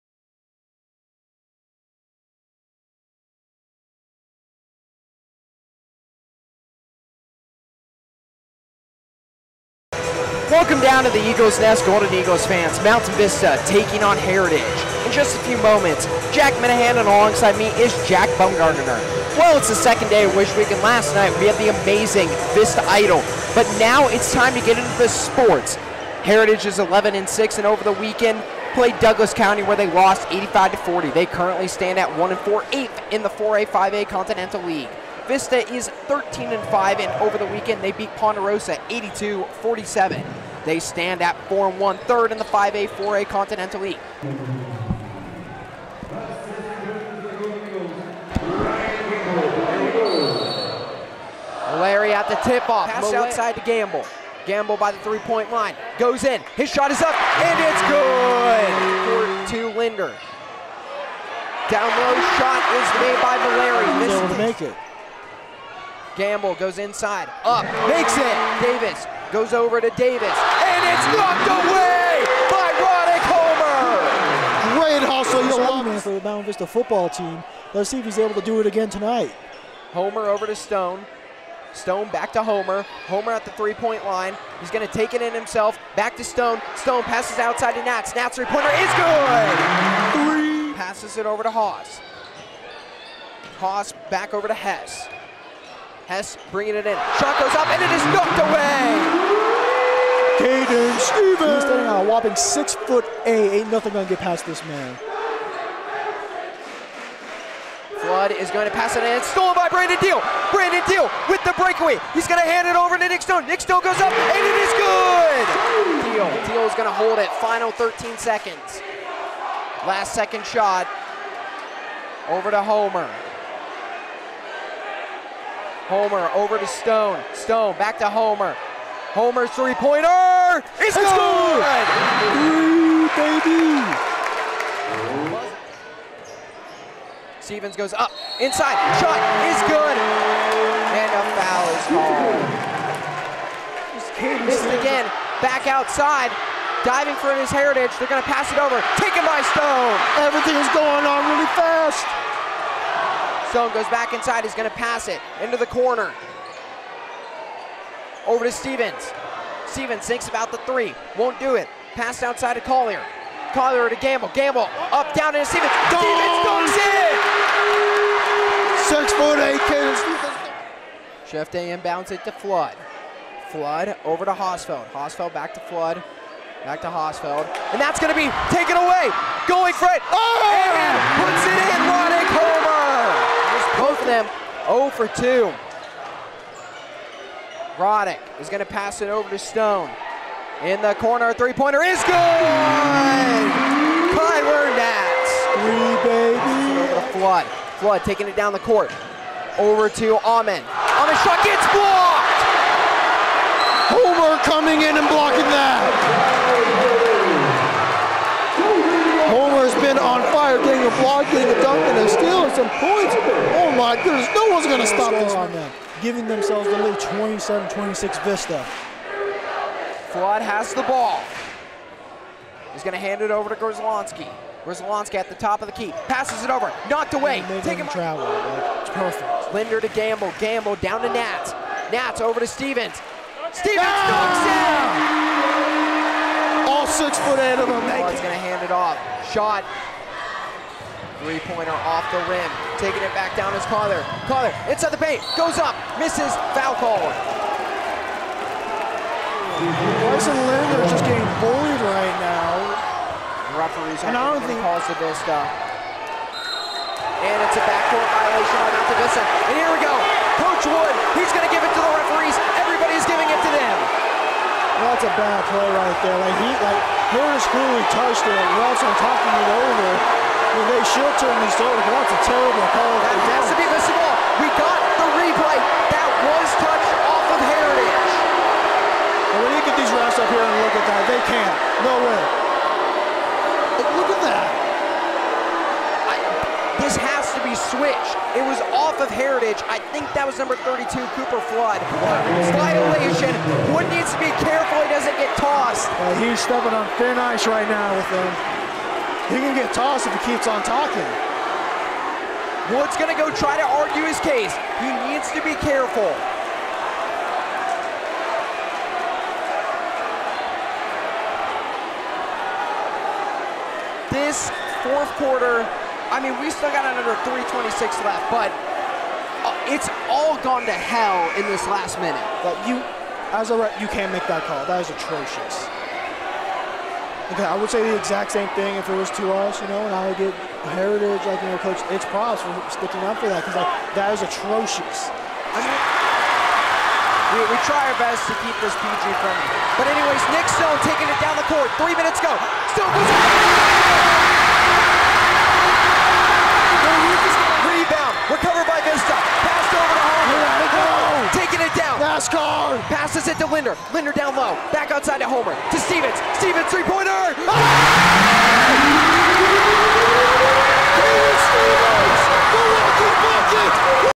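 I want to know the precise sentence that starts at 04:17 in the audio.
And it's a backdoor violation on Altavista.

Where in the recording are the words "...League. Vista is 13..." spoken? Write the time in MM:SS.
00:34.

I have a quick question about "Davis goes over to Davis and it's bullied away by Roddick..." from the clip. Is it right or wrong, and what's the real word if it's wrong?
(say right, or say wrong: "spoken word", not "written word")
wrong: "knocked", not "bullied".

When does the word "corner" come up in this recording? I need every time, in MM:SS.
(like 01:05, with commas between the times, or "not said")
02:35, 03:10.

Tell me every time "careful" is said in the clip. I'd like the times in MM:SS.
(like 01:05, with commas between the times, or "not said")
04:54, 05:05.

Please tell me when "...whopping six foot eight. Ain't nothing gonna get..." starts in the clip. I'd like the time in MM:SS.
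01:42.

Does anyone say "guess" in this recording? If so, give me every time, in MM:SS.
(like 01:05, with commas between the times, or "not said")
not said.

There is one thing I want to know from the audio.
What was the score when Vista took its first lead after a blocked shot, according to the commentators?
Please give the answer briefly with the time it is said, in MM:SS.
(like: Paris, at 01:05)
27-26, at 03:36.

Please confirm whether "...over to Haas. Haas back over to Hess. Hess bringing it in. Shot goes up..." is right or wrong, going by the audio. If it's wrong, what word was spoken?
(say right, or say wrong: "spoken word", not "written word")
right.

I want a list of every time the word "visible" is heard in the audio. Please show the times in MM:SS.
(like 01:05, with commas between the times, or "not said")
04:33.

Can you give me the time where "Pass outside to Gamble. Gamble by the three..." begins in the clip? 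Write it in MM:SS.
00:52.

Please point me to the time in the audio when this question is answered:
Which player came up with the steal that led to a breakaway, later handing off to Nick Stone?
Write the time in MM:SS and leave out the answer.
01:49.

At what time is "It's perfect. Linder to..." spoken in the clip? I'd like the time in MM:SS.
03:48.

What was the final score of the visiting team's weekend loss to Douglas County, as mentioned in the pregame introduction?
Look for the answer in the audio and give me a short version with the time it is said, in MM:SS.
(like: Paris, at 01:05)
85-40, at 00:30.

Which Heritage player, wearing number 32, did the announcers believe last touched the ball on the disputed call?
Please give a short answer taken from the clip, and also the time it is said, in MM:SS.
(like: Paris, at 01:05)
Cooper Flood, at 04:51.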